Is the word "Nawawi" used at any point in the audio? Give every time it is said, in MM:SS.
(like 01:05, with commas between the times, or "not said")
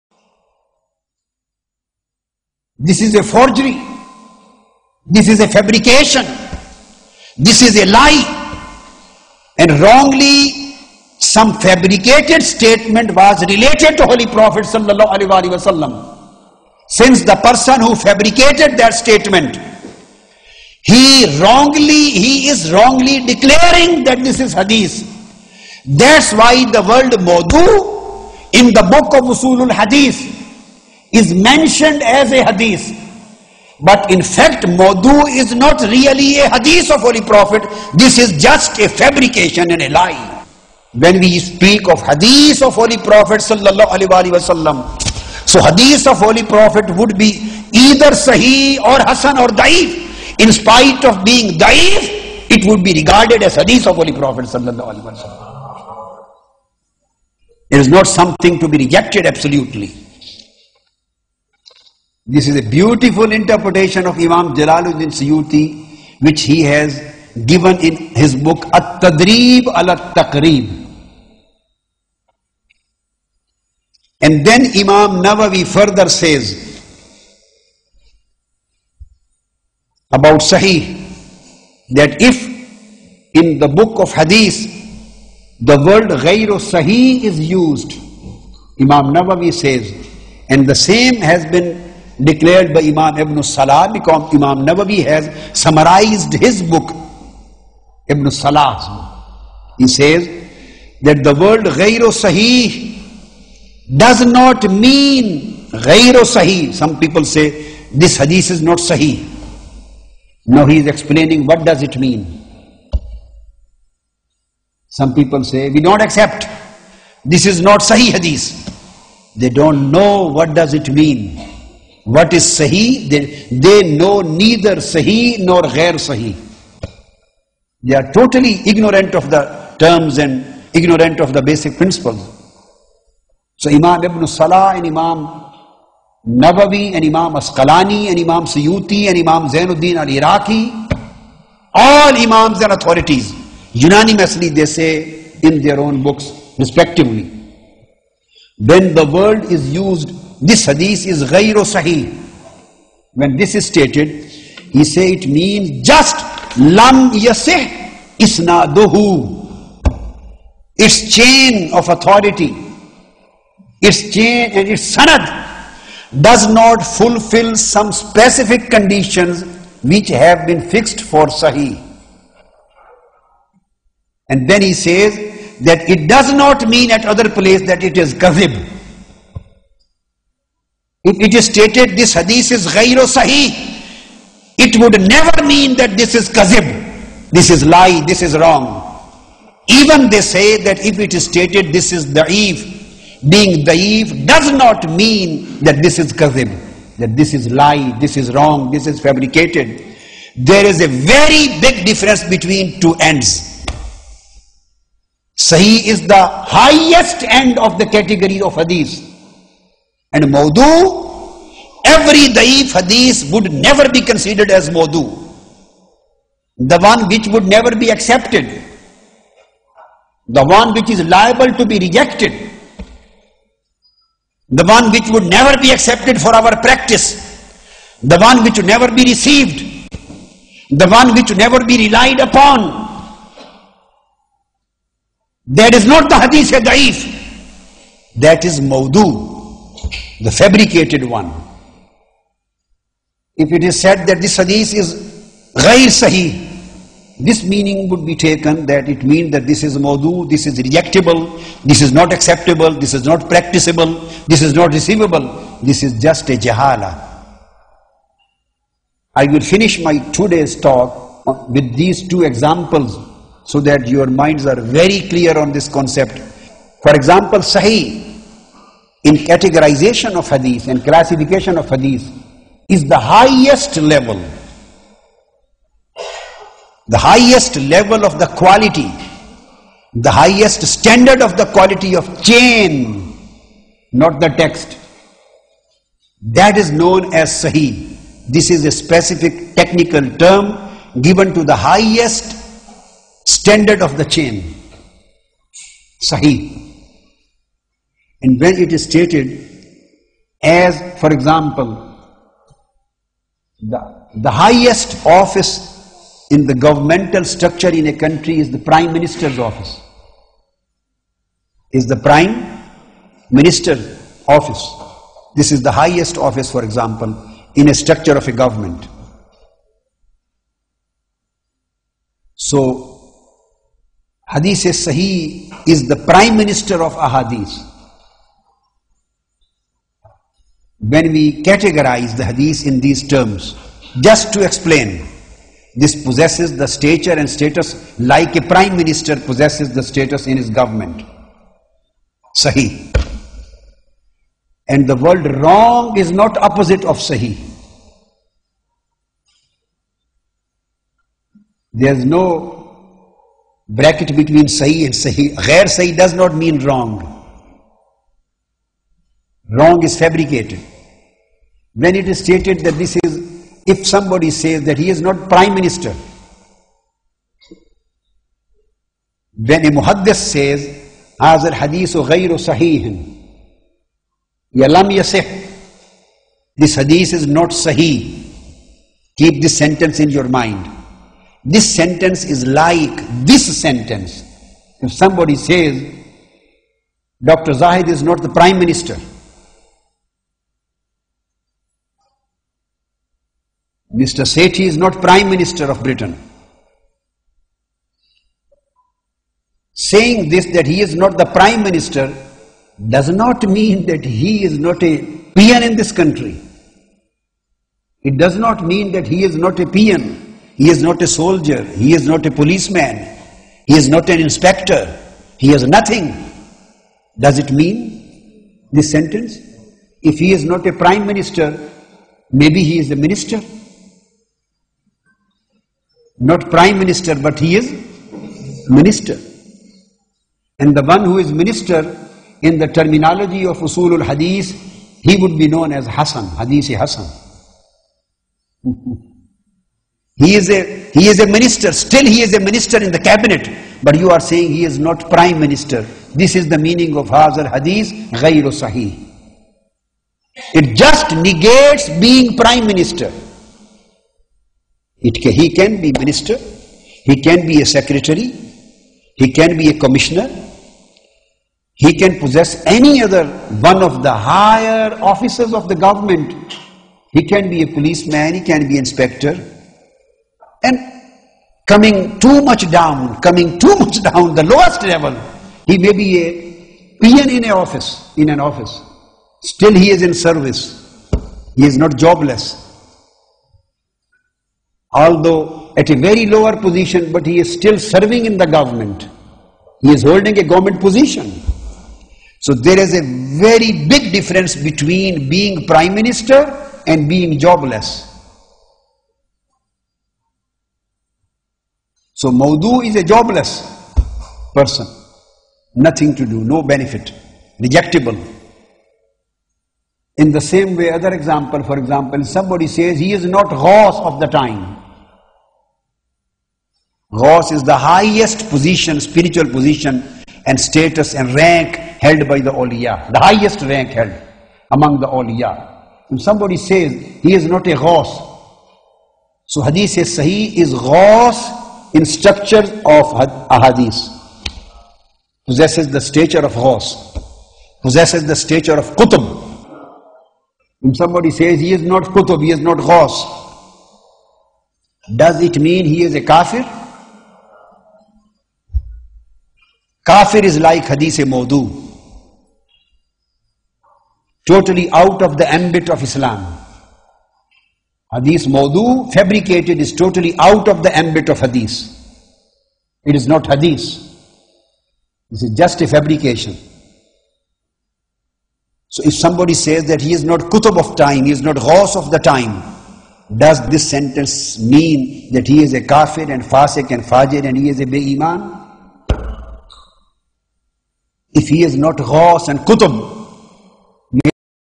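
01:15, 01:29, 01:34.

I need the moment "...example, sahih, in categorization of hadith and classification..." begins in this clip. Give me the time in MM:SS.
04:26.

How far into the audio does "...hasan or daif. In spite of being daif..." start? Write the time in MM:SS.
00:48.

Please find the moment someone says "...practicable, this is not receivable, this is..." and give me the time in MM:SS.
04:13.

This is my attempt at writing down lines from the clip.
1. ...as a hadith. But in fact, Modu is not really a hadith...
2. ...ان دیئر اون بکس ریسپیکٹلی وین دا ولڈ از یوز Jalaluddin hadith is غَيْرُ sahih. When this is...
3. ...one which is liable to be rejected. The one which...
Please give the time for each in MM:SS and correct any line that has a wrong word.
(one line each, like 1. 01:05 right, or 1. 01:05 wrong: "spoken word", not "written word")
1. 00:32 right
2. 02:25 wrong: "This", not "Jalaluddin"
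3. 03:40 right.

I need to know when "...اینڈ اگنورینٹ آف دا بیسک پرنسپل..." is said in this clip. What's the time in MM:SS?
02:10.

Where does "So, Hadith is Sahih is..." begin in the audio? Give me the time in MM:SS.
05:22.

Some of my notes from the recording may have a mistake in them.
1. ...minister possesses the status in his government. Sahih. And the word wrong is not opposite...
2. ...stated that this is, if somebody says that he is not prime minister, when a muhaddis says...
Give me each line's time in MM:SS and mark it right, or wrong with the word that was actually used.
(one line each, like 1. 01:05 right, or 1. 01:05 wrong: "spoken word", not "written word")
1. 05:38 right
2. 06:02 right.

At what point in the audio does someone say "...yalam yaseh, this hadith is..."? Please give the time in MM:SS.
06:14.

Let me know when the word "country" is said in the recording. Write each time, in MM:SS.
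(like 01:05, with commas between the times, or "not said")
05:07, 06:45.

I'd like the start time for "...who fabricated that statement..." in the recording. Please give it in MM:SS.
00:17.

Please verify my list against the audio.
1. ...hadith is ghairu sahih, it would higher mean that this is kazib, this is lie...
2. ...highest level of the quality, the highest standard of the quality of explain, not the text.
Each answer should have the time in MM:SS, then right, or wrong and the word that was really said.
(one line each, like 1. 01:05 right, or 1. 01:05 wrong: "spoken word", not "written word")
1. 03:02 wrong: "never", not "higher"
2. 04:36 wrong: "chain", not "explain".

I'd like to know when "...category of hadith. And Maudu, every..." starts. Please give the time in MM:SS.
03:27.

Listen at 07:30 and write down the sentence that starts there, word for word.
It just negates being prime minister.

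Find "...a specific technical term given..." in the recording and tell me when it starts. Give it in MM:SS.
04:48.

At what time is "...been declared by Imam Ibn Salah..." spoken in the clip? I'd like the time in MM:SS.
01:31.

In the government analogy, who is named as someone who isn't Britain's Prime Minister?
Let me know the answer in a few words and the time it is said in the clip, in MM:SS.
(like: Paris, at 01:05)
Mr. Sethi, at 06:33.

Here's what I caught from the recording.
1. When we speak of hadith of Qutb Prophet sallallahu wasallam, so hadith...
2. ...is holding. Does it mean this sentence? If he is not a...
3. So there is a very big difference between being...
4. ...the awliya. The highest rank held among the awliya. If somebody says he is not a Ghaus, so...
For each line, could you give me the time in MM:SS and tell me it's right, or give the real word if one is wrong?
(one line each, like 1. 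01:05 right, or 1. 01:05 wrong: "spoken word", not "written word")
1. 00:40 wrong: "Holy", not "Qutb"
2. 06:55 wrong: "nothing", not "holding"
3. 08:12 right
4. 08:42 right.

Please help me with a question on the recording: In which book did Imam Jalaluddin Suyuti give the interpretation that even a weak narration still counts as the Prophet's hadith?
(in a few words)
At-Tadrib al-Taqrib.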